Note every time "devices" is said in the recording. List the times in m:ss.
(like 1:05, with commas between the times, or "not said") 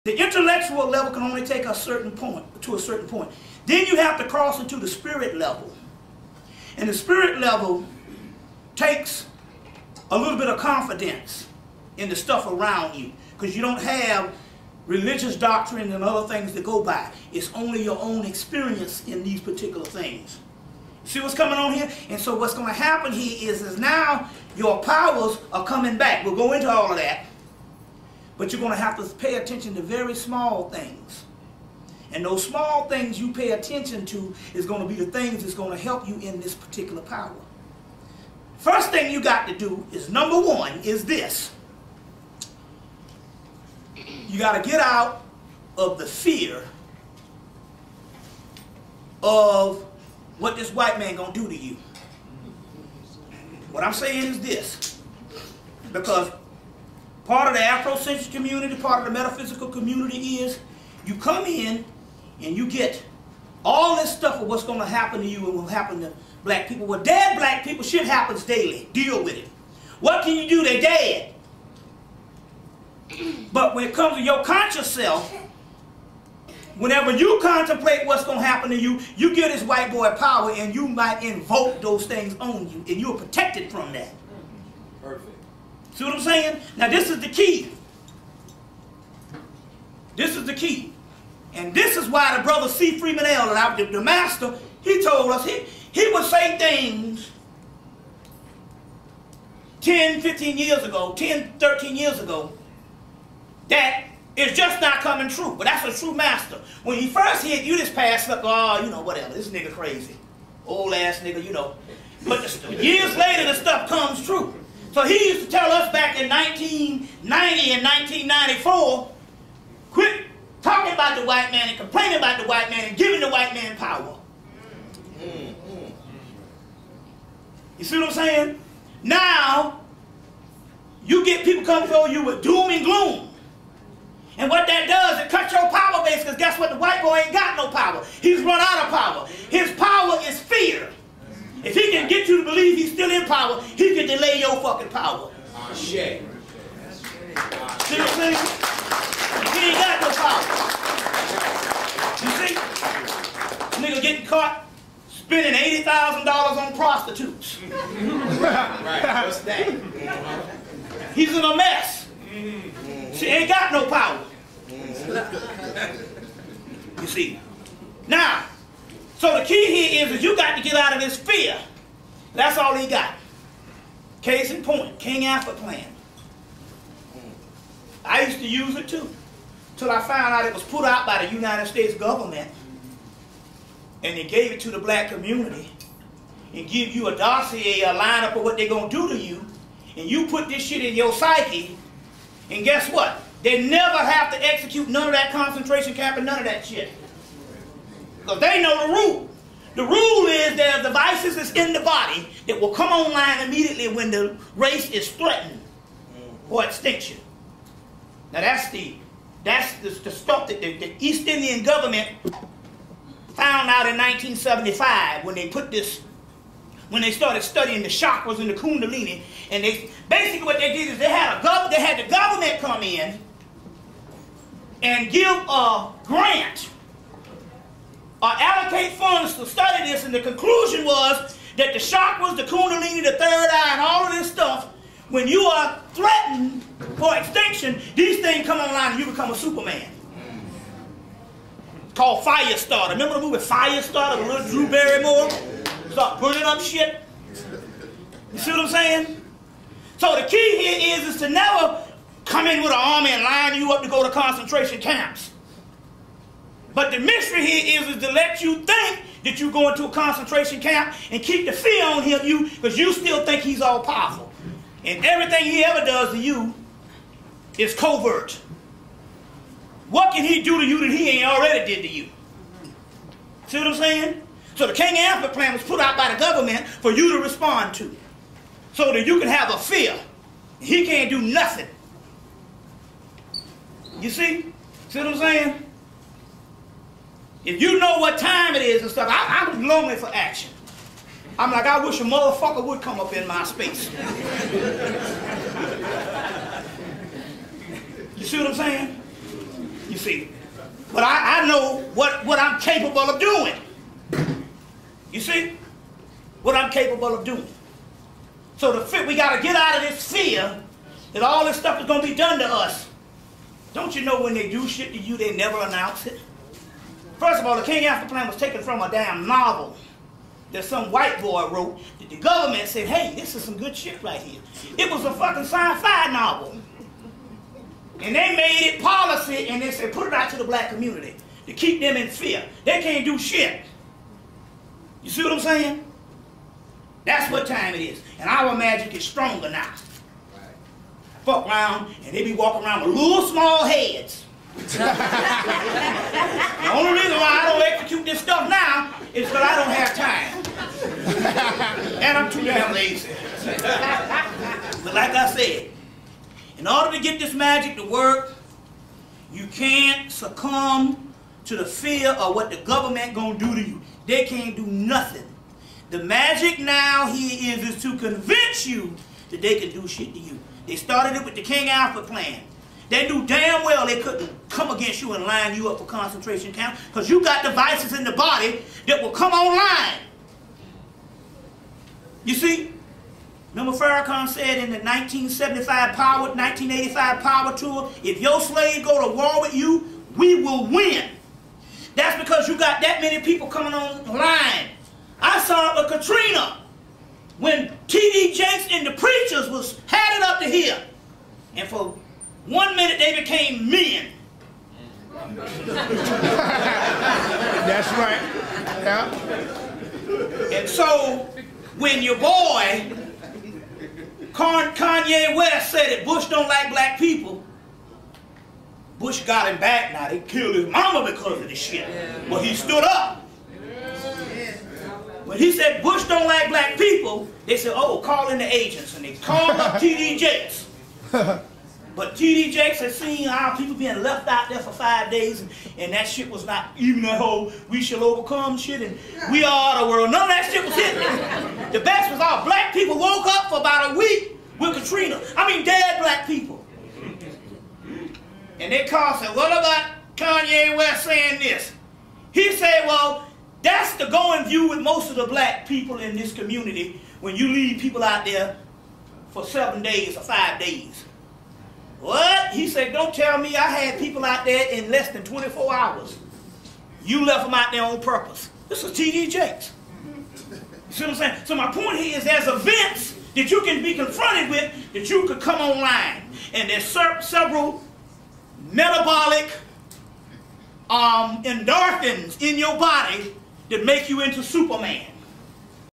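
3:20, 6:17.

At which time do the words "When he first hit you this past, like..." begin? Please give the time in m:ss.
1:46.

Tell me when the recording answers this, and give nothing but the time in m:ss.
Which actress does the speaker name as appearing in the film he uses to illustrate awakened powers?
4:04.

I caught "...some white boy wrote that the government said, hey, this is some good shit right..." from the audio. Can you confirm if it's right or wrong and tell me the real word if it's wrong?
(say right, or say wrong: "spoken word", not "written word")
right.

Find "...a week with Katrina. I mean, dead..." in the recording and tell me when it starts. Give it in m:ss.
7:23.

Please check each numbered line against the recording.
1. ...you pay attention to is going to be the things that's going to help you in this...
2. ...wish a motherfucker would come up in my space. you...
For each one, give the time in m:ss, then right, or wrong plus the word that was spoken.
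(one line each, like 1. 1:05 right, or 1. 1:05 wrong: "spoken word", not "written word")
1. 0:33 right
2. 4:51 right.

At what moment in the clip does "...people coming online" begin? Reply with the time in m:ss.
6:33.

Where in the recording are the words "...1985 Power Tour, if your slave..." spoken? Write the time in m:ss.
6:26.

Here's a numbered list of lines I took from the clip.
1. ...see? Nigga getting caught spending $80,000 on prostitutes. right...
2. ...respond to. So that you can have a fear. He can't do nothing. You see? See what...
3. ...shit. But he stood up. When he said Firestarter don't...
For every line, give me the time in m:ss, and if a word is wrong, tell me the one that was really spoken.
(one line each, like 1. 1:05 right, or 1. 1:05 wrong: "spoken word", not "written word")
1. 2:32 right
2. 4:37 right
3. 7:01 wrong: "Bush", not "Firestarter".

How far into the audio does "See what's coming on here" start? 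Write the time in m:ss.
0:21.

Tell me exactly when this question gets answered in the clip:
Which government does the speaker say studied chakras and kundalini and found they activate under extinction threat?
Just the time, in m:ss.
3:30.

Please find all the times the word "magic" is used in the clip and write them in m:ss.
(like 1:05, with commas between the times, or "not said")
5:38, 5:57, 6:06.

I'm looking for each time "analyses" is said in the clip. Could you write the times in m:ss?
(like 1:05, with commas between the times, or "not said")
not said.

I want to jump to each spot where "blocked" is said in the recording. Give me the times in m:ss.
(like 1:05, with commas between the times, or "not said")
not said.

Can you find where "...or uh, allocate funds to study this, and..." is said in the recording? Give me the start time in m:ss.
3:48.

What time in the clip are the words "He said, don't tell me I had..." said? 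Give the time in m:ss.
7:42.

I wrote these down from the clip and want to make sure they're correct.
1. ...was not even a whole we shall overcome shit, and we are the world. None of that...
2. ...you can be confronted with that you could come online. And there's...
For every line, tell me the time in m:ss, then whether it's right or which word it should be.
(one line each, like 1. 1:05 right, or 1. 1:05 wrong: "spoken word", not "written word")
1. 7:16 right
2. 7:53 right.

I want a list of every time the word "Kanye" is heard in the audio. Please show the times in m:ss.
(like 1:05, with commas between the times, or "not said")
6:54, 7:30.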